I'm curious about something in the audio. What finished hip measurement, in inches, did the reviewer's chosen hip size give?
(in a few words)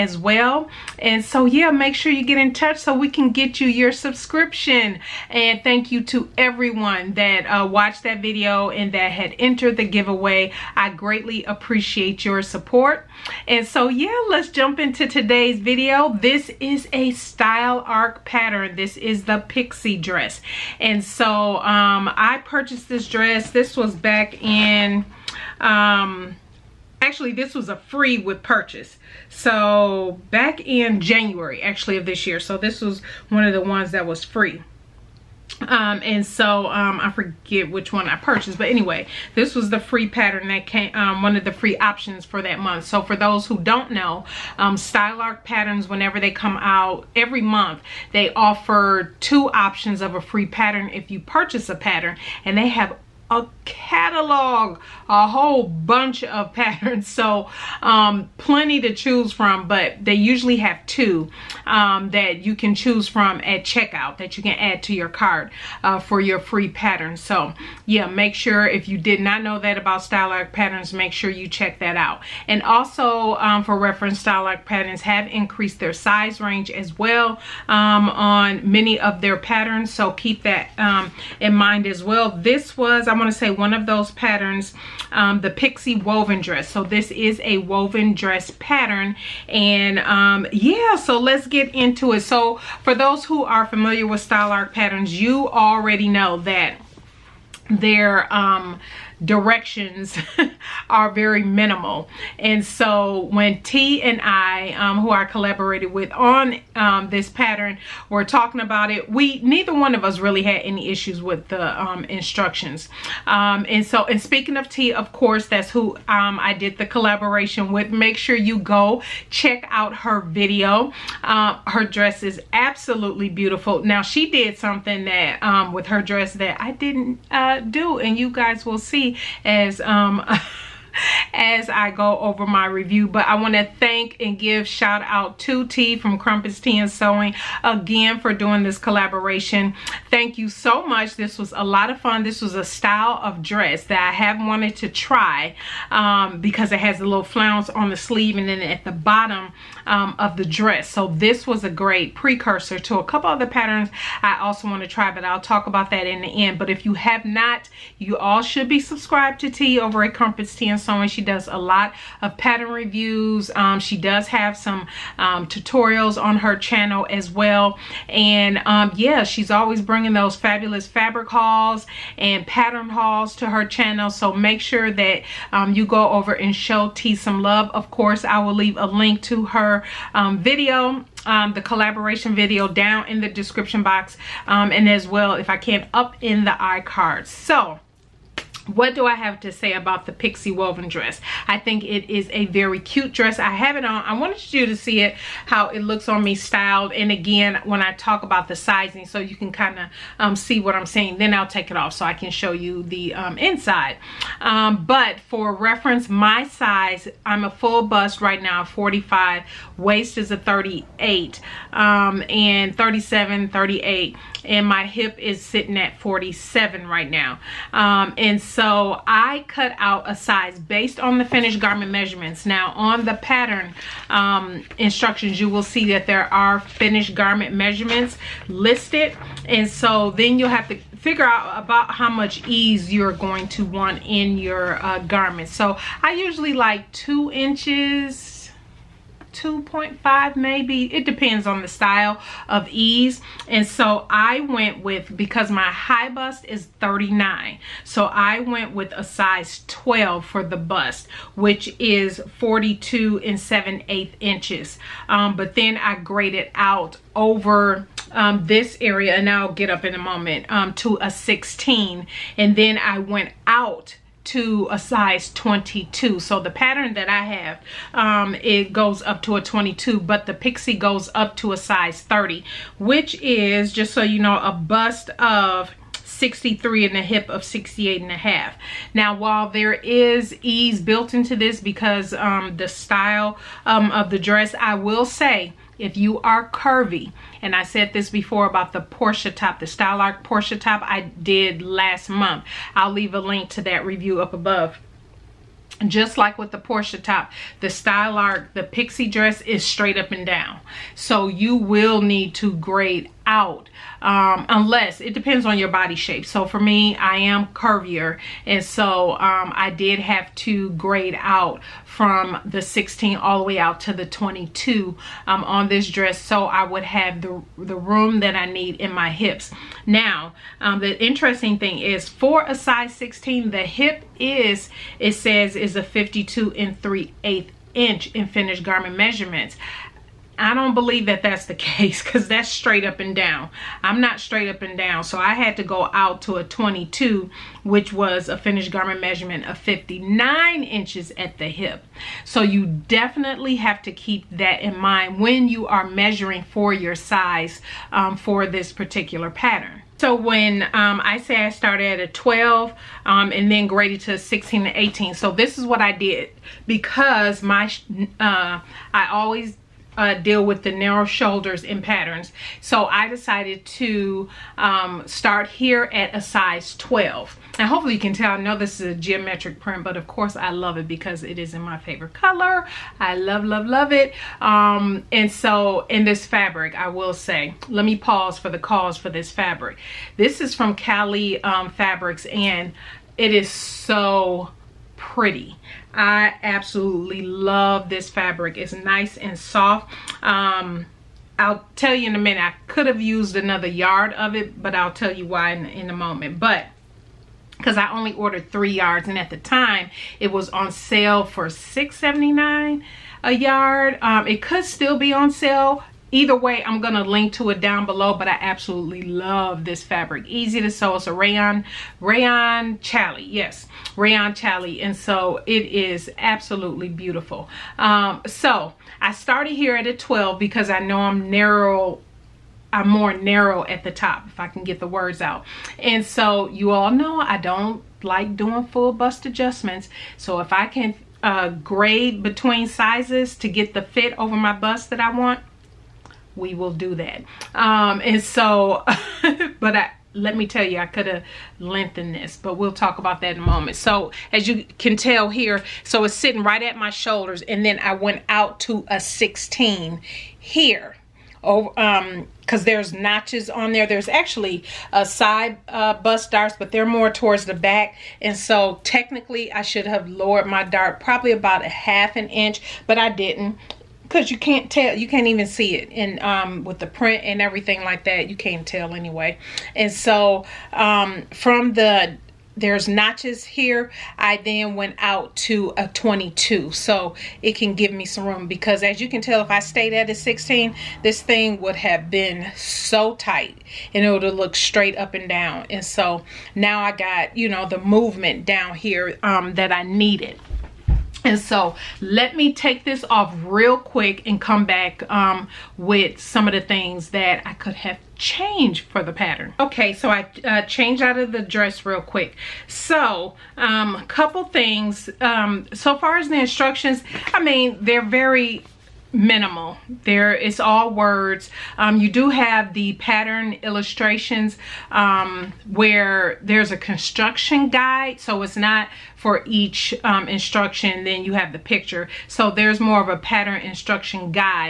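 59 inches.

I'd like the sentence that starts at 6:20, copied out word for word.
This is from Cali um, Fabrics and it is so pretty.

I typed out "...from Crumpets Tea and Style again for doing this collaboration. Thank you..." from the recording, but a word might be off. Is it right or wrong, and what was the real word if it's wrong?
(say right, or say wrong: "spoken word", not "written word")
wrong: "Sewing", not "Style".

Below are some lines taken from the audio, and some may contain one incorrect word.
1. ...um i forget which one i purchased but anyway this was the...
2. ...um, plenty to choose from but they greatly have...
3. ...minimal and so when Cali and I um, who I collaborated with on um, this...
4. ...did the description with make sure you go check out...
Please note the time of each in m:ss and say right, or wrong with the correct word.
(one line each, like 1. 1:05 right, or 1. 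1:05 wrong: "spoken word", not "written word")
1. 0:36 right
2. 0:57 wrong: "usually", not "greatly"
3. 1:41 wrong: "Tea", not "Cali"
4. 1:56 wrong: "collaboration", not "description".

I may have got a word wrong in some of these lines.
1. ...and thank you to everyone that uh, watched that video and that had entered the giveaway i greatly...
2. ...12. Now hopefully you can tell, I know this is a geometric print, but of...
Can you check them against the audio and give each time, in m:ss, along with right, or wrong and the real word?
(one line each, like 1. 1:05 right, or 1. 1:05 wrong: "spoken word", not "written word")
1. 0:05 right
2. 6:06 right.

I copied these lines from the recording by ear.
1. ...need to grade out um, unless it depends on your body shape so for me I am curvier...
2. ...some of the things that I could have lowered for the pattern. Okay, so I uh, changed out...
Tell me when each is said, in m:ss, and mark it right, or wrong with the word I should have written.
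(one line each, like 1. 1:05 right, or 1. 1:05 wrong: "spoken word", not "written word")
1. 5:02 right
2. 8:16 wrong: "changed", not "lowered".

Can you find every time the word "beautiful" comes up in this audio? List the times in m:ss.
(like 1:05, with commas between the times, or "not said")
2:03, 6:56.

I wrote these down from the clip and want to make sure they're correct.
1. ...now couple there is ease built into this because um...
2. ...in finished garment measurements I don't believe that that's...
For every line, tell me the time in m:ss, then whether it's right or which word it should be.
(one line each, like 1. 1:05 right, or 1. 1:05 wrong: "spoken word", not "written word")
1. 4:38 wrong: "while", not "couple"
2. 5:28 right.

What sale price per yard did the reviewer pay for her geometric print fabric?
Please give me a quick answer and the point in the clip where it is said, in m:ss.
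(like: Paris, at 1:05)
$6.79, at 6:41.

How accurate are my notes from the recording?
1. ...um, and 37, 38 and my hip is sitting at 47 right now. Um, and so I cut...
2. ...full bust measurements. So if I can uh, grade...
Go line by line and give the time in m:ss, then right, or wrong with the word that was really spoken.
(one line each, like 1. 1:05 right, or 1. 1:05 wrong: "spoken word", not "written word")
1. 3:31 right
2. 7:08 wrong: "adjustments", not "measurements".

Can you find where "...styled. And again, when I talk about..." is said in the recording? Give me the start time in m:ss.
3:16.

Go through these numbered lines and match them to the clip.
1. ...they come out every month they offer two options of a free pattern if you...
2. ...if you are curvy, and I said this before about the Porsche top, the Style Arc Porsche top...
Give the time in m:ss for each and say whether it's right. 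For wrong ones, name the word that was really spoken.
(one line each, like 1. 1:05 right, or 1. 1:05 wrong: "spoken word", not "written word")
1. 0:46 right
2. 4:45 right.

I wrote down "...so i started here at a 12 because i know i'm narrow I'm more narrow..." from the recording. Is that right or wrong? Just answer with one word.
right.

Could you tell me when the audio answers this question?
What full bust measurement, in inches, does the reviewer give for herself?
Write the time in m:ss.
3:28.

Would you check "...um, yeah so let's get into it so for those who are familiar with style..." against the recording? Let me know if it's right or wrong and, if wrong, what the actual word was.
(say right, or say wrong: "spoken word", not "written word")
right.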